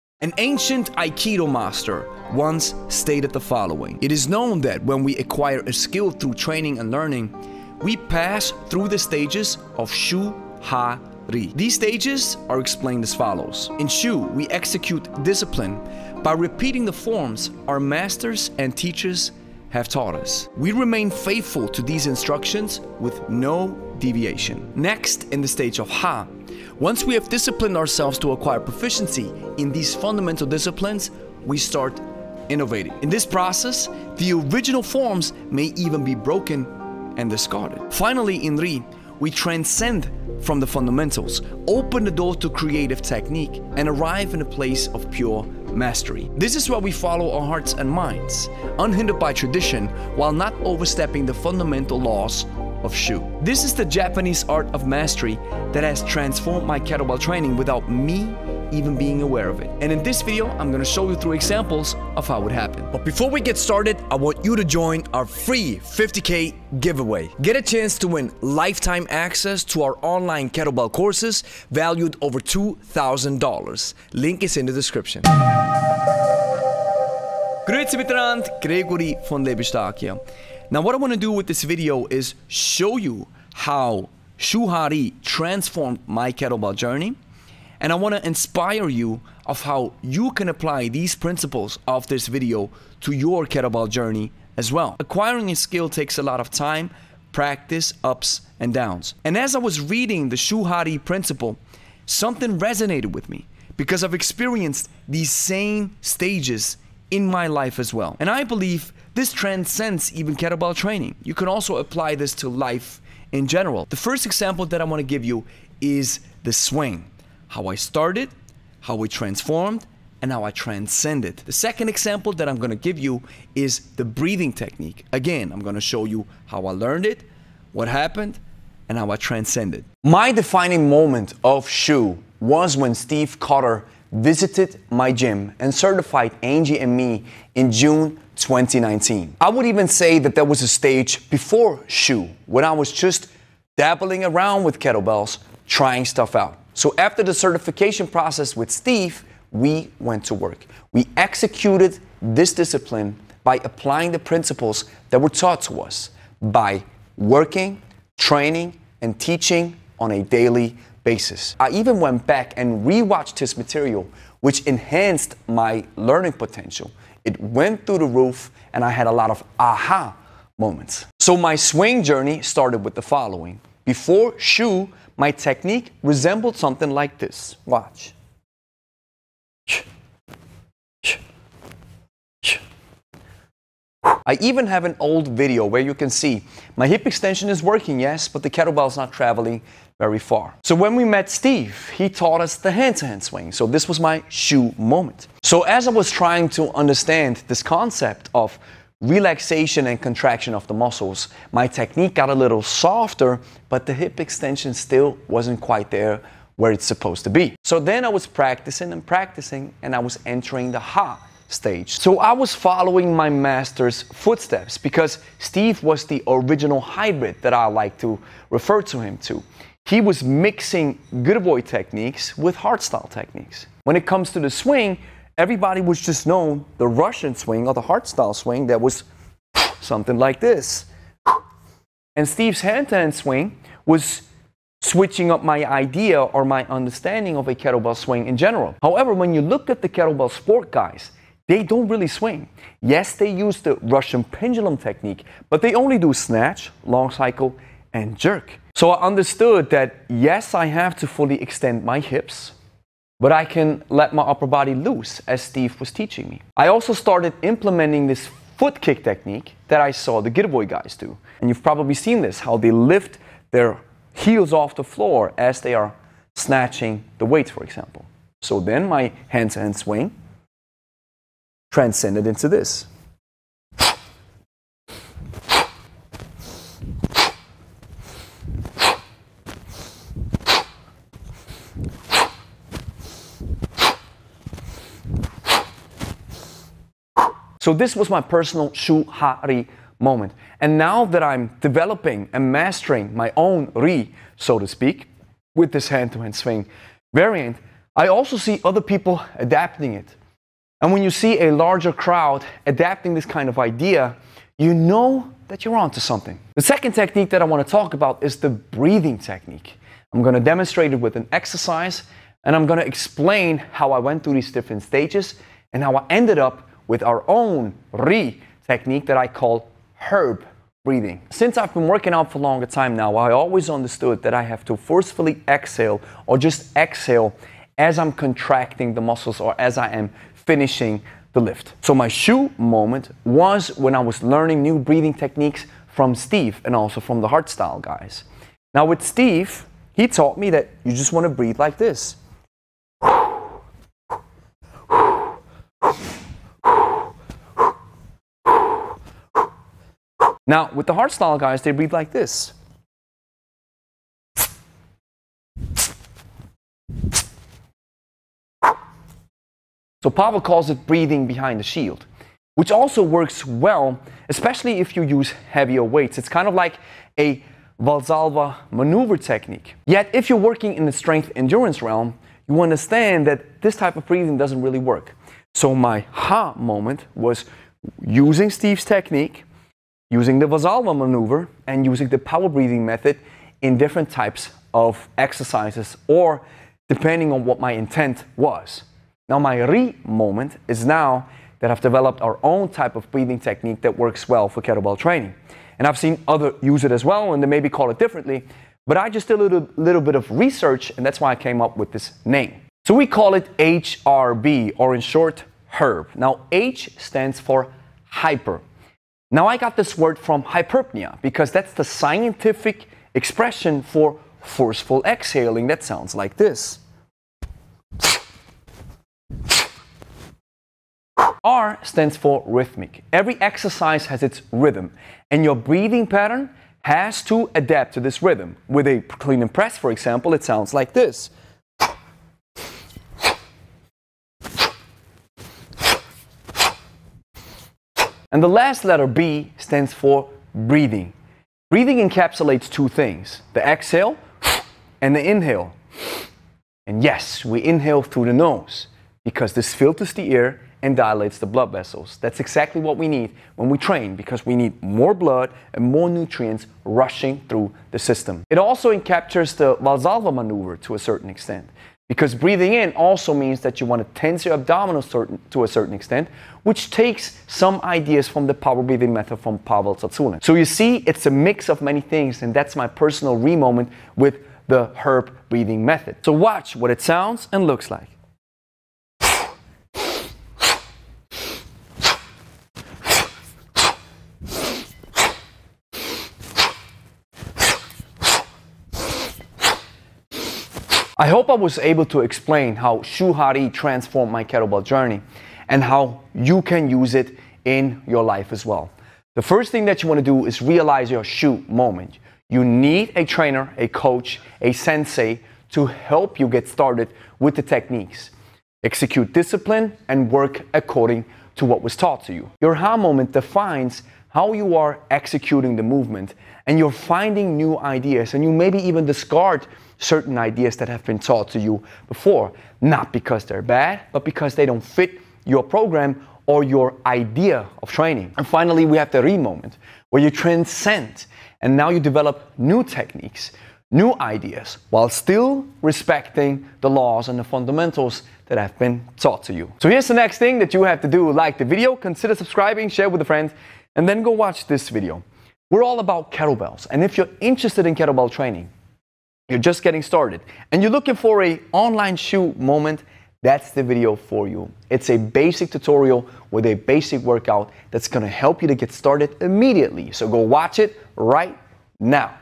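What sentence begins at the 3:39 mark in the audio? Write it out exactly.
He was mixing Girevoy techniques with hardstyle techniques.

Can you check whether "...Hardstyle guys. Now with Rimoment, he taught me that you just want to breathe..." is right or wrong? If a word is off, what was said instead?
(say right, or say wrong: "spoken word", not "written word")
wrong: "Steve", not "Rimoment".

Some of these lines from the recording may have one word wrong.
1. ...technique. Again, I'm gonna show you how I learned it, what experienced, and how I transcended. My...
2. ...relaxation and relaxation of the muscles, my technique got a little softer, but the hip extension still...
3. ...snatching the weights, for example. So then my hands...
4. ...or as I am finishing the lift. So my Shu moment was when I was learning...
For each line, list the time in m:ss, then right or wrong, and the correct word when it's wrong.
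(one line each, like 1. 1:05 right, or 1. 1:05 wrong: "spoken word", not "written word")
1. 2:04 wrong: "happened", not "experienced"
2. 3:19 wrong: "contraction", not "relaxation"
3. 4:26 right
4. 5:29 right.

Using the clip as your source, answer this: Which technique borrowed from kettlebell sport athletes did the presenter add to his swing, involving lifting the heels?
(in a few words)
foot kick technique.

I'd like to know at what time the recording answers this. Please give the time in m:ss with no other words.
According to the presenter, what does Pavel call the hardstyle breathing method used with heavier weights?
6:00.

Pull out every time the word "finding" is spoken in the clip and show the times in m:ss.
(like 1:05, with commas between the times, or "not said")
8:36.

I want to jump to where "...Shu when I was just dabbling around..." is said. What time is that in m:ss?
2:21.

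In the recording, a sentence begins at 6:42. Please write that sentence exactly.
So we call it HRB or in short HERB.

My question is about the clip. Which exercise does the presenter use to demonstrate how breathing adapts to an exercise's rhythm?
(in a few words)
clean and press.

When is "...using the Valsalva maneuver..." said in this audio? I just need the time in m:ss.
6:20.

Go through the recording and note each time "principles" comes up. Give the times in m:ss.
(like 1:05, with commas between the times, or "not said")
1:31, 1:41, 2:34.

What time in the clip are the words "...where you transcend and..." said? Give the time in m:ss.
8:50.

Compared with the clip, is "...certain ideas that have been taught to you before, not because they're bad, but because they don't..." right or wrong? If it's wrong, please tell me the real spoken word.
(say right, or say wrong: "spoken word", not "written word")
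right.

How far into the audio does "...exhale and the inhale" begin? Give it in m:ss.
7:23.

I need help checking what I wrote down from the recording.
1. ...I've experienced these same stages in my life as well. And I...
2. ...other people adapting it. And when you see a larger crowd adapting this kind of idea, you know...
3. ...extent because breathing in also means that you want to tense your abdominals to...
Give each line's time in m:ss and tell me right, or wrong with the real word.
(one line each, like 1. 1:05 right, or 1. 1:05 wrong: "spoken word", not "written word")
1. 1:44 right
2. 4:58 right
3. 7:41 right.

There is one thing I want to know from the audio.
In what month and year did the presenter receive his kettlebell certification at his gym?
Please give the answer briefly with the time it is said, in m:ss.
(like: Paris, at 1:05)
June 2019, at 2:17.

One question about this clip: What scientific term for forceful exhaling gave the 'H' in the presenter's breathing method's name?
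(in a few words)
hyperpnea.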